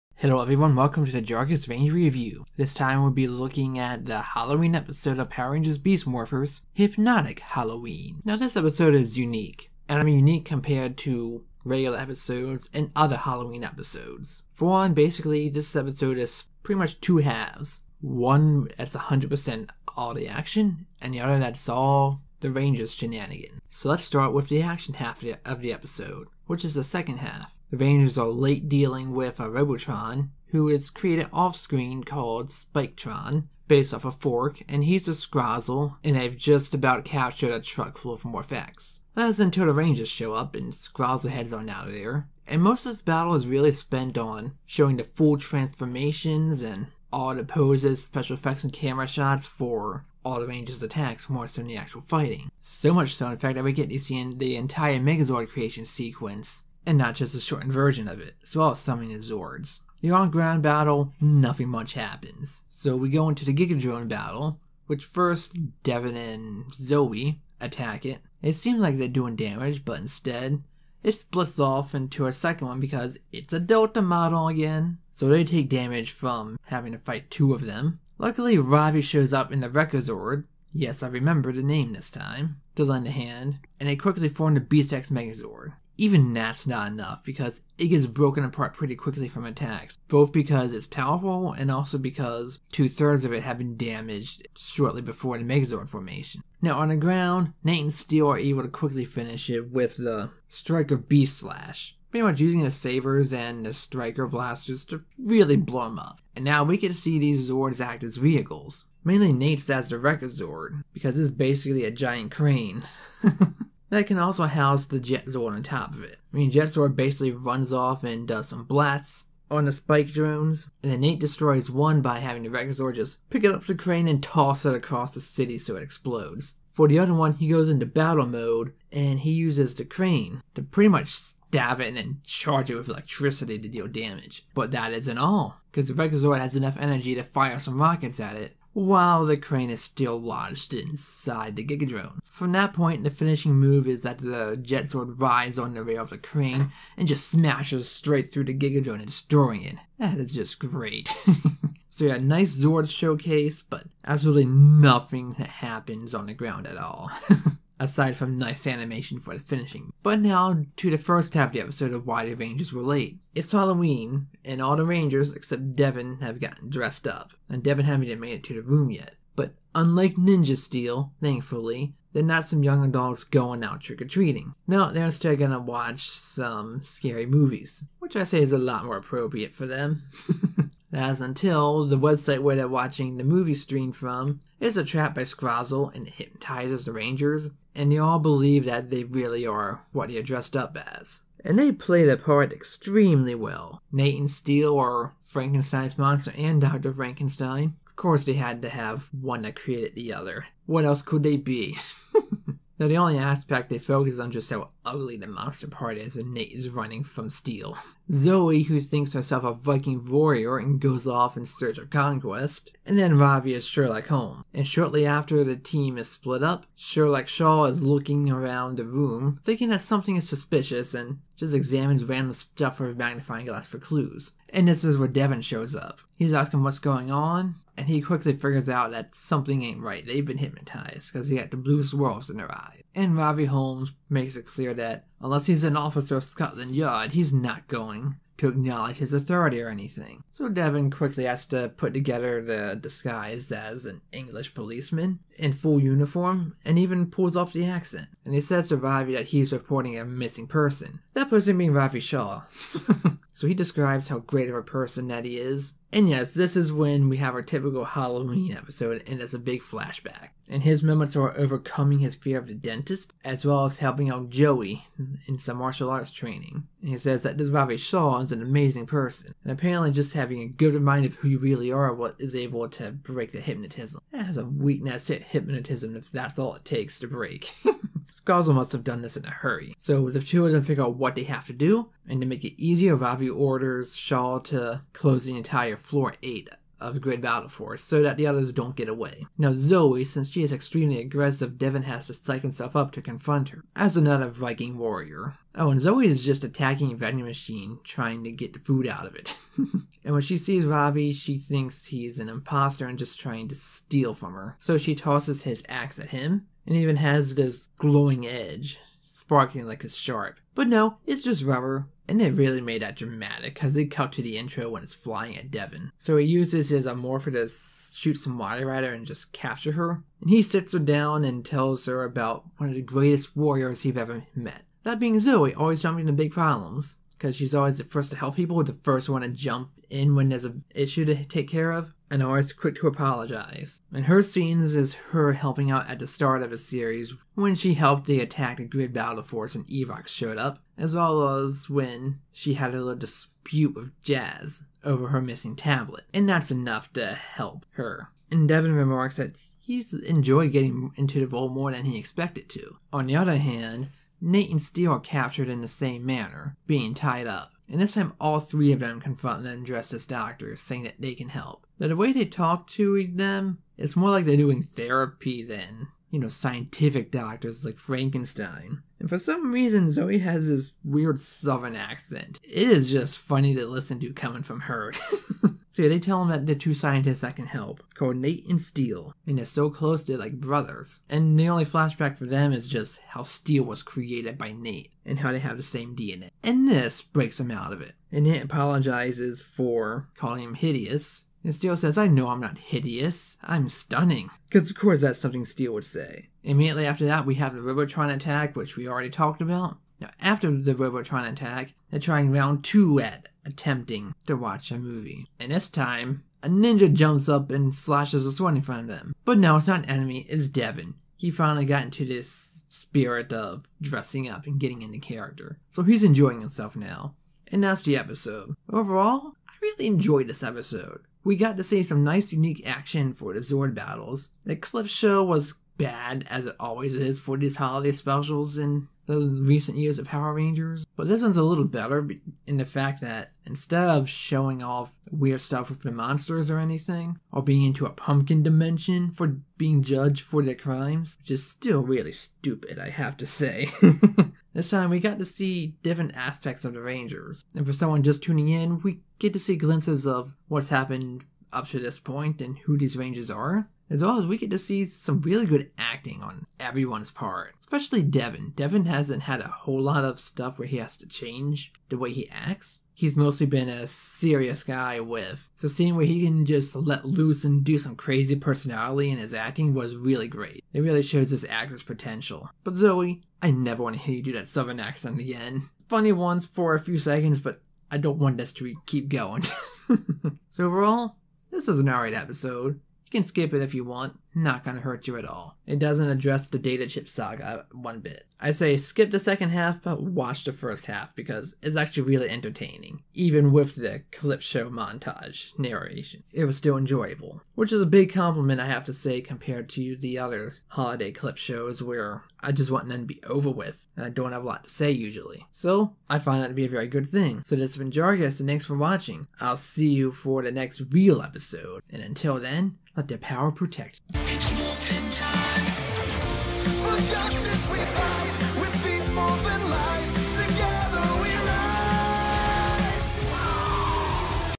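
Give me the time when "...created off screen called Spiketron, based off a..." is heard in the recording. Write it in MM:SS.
00:30.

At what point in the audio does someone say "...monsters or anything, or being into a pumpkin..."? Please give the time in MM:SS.
07:15.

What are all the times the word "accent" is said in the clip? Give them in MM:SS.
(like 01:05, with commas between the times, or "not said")
04:07, 06:11, 07:54.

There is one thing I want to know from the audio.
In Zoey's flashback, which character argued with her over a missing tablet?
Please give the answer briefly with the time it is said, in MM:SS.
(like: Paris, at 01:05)
Jazz, at 05:44.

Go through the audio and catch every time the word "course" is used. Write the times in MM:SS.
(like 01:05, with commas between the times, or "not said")
03:17, 06:34.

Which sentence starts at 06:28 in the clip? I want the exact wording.
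And Nate apologizes for calling him hideous.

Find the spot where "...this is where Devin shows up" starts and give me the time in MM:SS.
03:44.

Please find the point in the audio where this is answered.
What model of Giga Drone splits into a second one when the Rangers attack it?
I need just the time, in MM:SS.
01:13.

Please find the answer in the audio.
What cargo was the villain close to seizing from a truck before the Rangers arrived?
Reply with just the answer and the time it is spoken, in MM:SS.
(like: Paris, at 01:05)
Morph-X, at 00:38.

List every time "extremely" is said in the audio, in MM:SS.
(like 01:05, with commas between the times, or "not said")
03:12, 04:50.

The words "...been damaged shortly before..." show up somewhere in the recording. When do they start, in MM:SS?
01:33.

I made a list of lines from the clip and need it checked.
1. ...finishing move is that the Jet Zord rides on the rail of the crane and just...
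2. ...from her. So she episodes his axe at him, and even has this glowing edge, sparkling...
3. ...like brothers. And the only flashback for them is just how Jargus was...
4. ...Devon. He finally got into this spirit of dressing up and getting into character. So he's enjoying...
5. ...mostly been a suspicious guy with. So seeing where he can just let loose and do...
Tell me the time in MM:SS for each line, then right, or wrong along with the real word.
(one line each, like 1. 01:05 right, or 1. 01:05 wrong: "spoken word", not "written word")
1. 02:23 right
2. 05:04 wrong: "tosses", not "episodes"
3. 06:20 wrong: "Steel", not "Jargus"
4. 06:50 right
5. 07:43 wrong: "serious", not "suspicious".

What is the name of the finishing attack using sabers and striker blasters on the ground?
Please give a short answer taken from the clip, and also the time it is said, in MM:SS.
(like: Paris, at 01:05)
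Striker Beast Slash, at 01:40.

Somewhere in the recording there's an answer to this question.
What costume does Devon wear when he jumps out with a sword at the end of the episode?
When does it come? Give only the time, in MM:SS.
06:46.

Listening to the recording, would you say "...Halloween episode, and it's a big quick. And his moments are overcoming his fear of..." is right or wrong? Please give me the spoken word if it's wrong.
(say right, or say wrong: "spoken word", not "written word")
wrong: "flashback", not "quick".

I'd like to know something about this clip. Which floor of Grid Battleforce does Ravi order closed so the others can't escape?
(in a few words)
Floor 8.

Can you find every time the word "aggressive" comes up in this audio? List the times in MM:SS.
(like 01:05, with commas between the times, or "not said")
04:50.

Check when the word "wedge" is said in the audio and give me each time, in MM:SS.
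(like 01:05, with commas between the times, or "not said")
not said.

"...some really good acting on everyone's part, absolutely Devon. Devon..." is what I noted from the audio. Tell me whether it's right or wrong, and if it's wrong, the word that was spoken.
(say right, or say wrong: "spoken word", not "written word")
wrong: "especially", not "absolutely".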